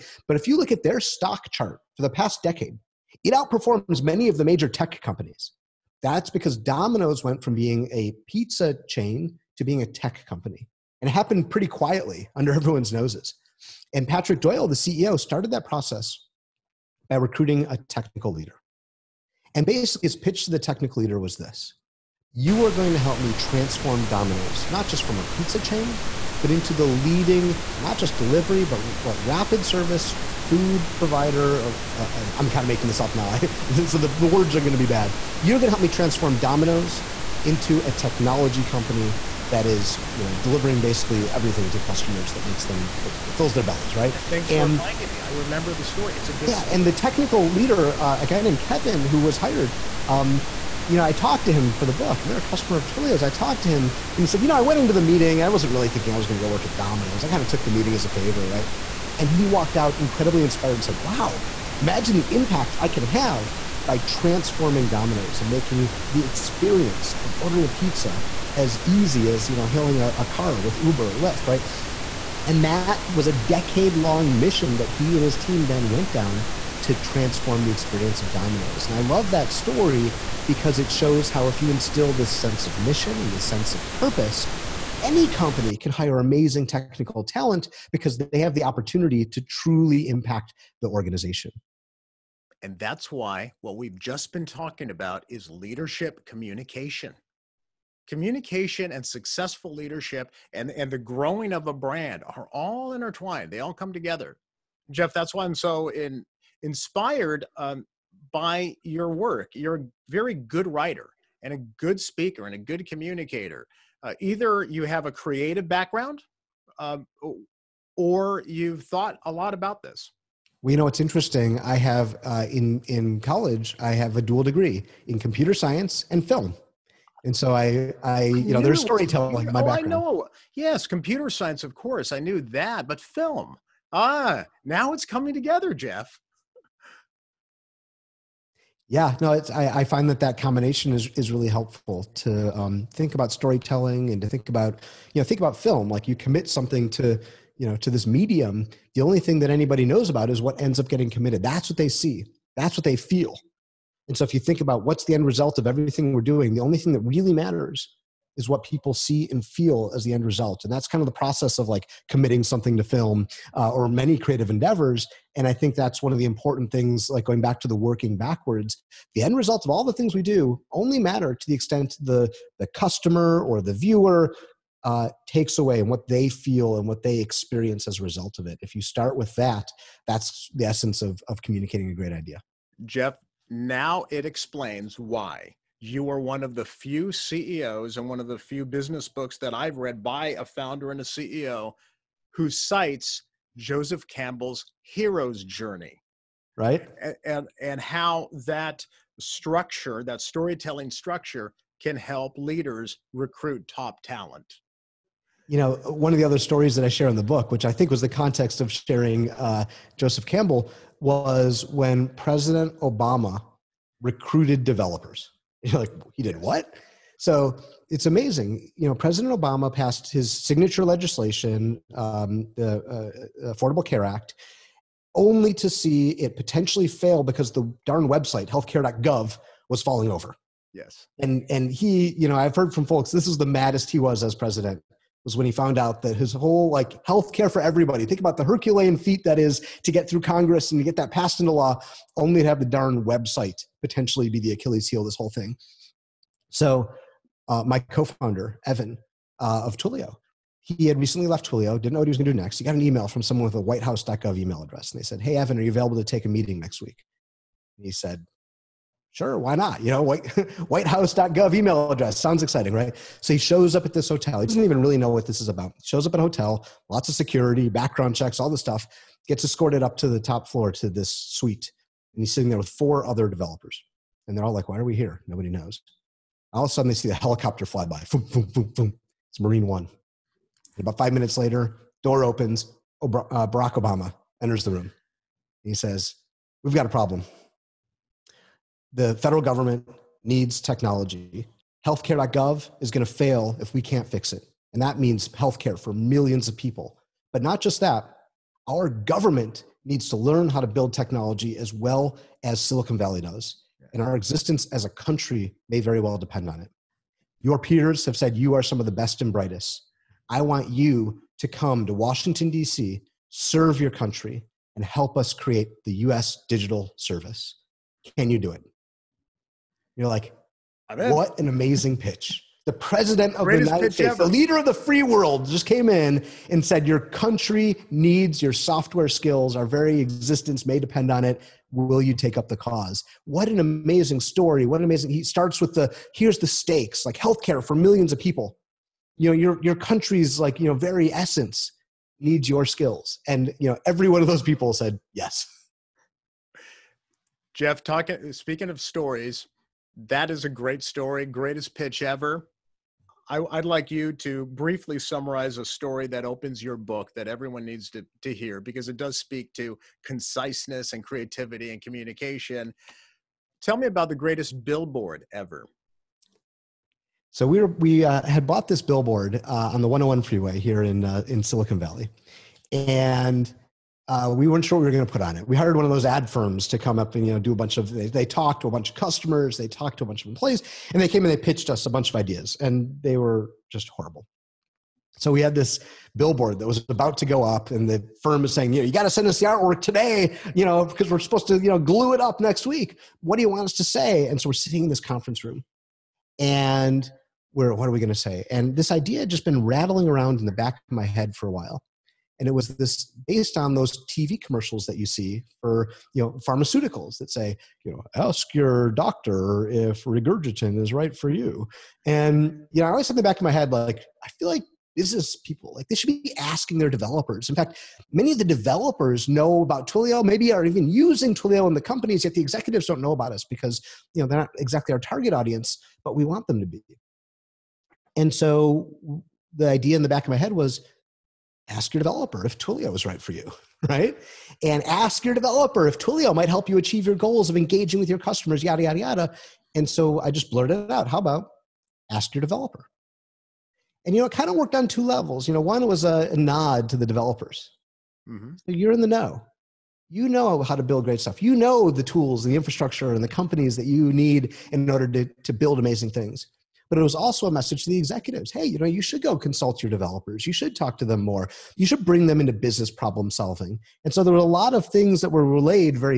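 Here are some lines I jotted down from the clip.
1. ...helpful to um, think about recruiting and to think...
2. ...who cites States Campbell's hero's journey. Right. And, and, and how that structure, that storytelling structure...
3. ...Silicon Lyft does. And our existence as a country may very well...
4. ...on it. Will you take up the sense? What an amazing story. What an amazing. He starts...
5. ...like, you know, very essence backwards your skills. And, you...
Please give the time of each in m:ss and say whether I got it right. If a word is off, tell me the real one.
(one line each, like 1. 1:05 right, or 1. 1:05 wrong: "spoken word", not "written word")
1. 2:21 wrong: "storytelling", not "recruiting"
2. 3:12 wrong: "Joseph", not "States"
3. 5:02 wrong: "Valley", not "Lyft"
4. 5:31 wrong: "cause", not "sense"
5. 5:40 wrong: "needs", not "backwards".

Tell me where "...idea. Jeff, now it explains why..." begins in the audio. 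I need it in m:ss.
3:02.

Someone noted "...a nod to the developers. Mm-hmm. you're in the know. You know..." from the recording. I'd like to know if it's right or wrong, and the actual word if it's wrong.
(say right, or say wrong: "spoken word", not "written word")
right.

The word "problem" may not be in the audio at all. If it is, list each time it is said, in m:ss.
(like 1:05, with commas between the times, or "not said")
4:46, 7:42.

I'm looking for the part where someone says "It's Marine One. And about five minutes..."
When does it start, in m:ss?
4:39.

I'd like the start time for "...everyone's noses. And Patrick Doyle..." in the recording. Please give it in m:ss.
0:12.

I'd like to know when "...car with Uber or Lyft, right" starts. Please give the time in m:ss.
1:10.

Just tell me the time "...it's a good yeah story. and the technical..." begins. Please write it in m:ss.
0:46.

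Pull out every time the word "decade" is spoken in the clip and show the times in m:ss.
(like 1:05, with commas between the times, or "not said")
0:02, 1:13.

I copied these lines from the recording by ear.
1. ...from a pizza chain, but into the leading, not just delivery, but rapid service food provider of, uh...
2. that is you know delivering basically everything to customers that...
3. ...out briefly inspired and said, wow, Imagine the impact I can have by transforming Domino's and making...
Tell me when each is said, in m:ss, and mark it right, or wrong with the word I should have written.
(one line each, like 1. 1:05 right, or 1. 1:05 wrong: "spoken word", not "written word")
1. 0:25 right
2. 0:39 right
3. 0:59 wrong: "incredibly", not "briefly".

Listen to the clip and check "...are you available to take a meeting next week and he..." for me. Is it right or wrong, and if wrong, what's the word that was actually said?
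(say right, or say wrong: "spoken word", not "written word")
right.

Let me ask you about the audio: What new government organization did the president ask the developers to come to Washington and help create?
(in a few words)
U.S. Digital Service.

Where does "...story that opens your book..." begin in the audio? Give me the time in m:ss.
5:55.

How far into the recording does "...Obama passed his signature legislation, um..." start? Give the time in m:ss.
3:39.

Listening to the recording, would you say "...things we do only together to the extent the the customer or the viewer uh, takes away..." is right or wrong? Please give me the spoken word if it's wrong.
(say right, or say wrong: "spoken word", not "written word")
wrong: "matter", not "together".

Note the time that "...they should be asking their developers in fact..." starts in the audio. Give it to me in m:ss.
6:55.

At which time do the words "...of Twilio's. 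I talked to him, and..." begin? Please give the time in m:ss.
0:52.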